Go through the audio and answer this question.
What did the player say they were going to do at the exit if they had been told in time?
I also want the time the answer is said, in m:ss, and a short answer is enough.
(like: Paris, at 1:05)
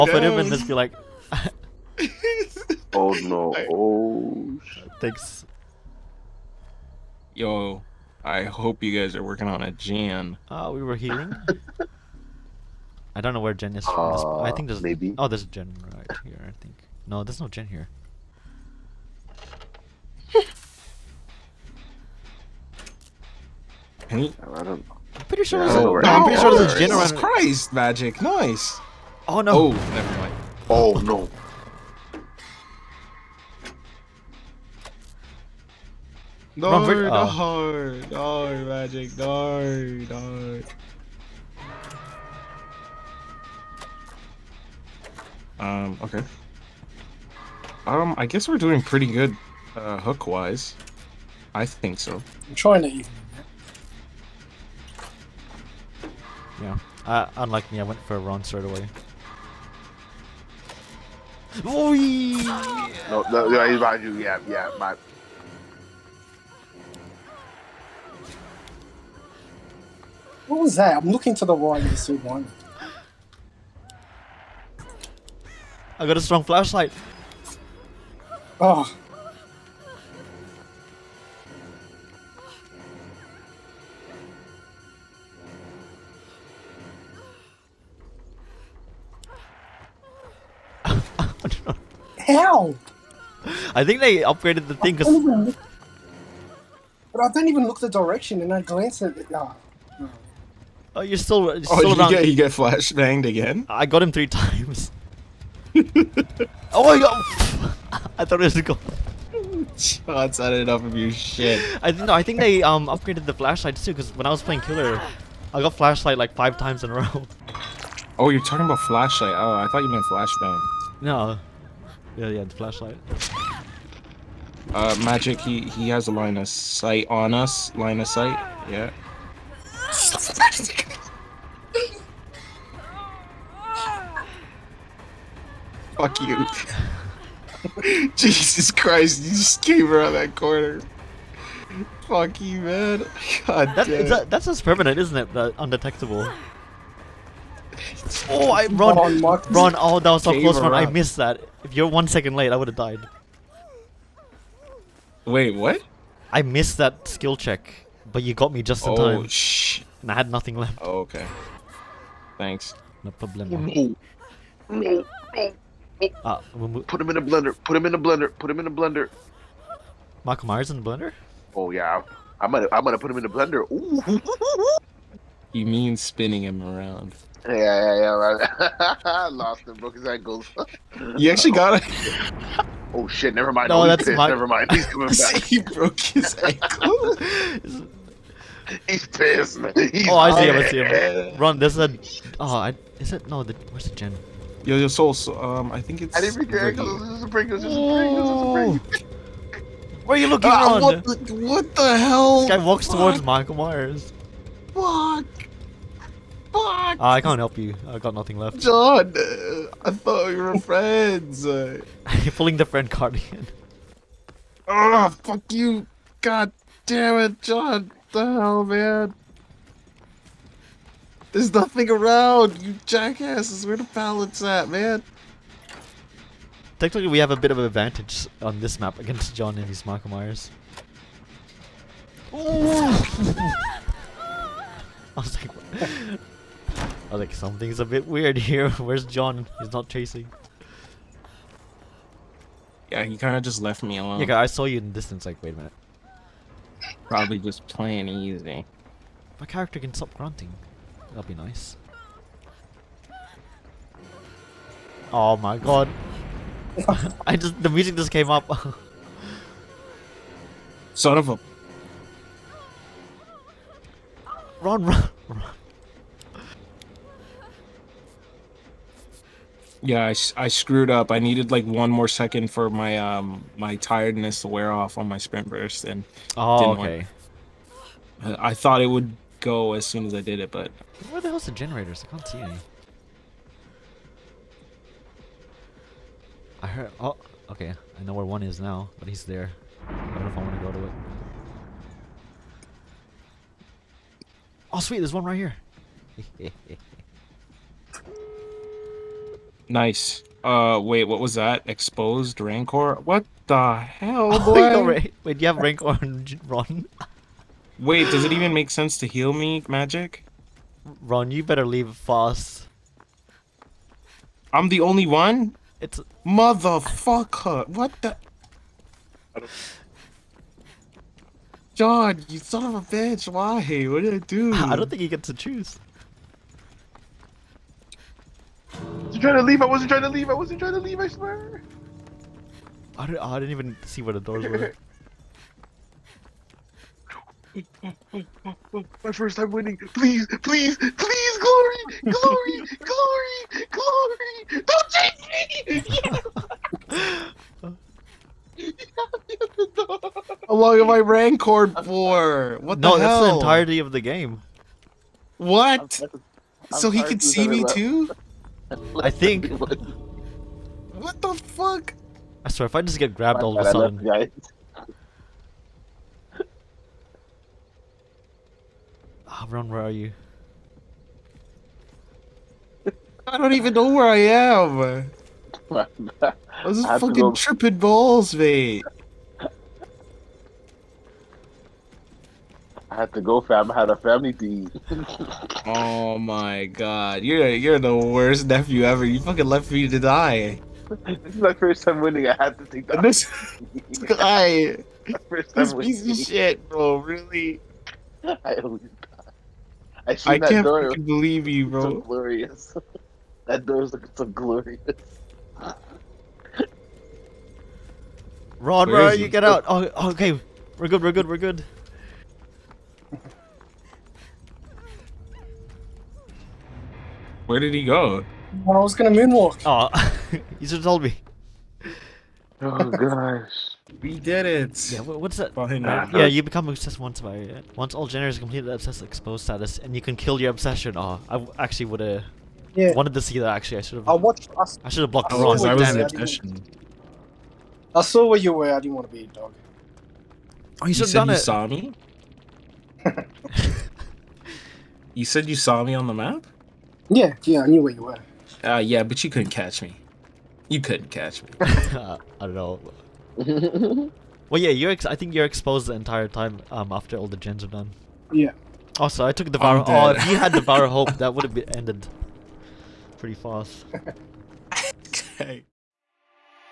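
moonwalk, at 6:59.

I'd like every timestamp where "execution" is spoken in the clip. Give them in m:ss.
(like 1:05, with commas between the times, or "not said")
not said.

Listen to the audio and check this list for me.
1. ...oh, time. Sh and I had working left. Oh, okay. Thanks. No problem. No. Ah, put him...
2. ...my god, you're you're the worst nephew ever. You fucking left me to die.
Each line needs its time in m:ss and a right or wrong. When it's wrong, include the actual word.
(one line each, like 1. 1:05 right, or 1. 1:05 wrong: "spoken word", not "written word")
1. 2:38 wrong: "nothing", not "working"
2. 6:26 right.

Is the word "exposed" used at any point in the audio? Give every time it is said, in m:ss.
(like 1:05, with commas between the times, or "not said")
5:01, 7:09, 7:35.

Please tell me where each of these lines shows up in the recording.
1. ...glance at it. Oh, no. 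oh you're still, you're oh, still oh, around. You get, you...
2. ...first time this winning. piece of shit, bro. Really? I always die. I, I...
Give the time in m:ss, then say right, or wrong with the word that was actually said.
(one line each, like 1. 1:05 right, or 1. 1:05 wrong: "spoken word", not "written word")
1. 1:38 right
2. 6:35 right.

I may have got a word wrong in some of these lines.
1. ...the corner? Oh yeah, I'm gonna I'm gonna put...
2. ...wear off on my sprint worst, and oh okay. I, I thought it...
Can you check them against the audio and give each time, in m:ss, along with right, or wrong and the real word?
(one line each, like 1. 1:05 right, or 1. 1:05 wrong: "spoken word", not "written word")
1. 2:50 wrong: "blender", not "corner"
2. 4:34 wrong: "burst", not "worst".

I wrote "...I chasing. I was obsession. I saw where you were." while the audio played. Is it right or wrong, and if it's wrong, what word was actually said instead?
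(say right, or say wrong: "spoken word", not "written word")
wrong: "wrong", not "chasing".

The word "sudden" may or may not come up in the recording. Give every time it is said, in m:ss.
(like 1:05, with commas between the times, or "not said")
6:03.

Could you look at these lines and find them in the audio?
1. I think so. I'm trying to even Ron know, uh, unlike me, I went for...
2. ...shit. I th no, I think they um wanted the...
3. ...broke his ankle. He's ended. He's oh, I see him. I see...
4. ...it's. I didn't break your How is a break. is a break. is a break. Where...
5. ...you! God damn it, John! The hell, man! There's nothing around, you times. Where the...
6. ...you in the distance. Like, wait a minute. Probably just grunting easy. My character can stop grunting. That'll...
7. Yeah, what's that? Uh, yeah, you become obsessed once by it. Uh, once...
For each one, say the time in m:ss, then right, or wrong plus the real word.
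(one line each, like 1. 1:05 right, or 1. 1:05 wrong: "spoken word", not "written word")
1. 0:51 wrong: "You", not "Ron"
2. 1:51 wrong: "upgraded", not "wanted"
3. 3:05 wrong: "pissed", not "ended"
4. 3:16 wrong: "This", not "How"
5. 3:35 wrong: "jackasses", not "times"
6. 4:04 wrong: "playing", not "grunting"
7. 7:04 right.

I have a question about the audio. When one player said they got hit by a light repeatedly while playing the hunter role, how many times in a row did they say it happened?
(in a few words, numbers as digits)
5.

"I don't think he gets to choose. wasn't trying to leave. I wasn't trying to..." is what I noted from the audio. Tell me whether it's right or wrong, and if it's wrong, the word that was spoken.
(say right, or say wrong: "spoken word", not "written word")
right.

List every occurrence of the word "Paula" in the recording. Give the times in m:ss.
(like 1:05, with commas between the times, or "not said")
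not said.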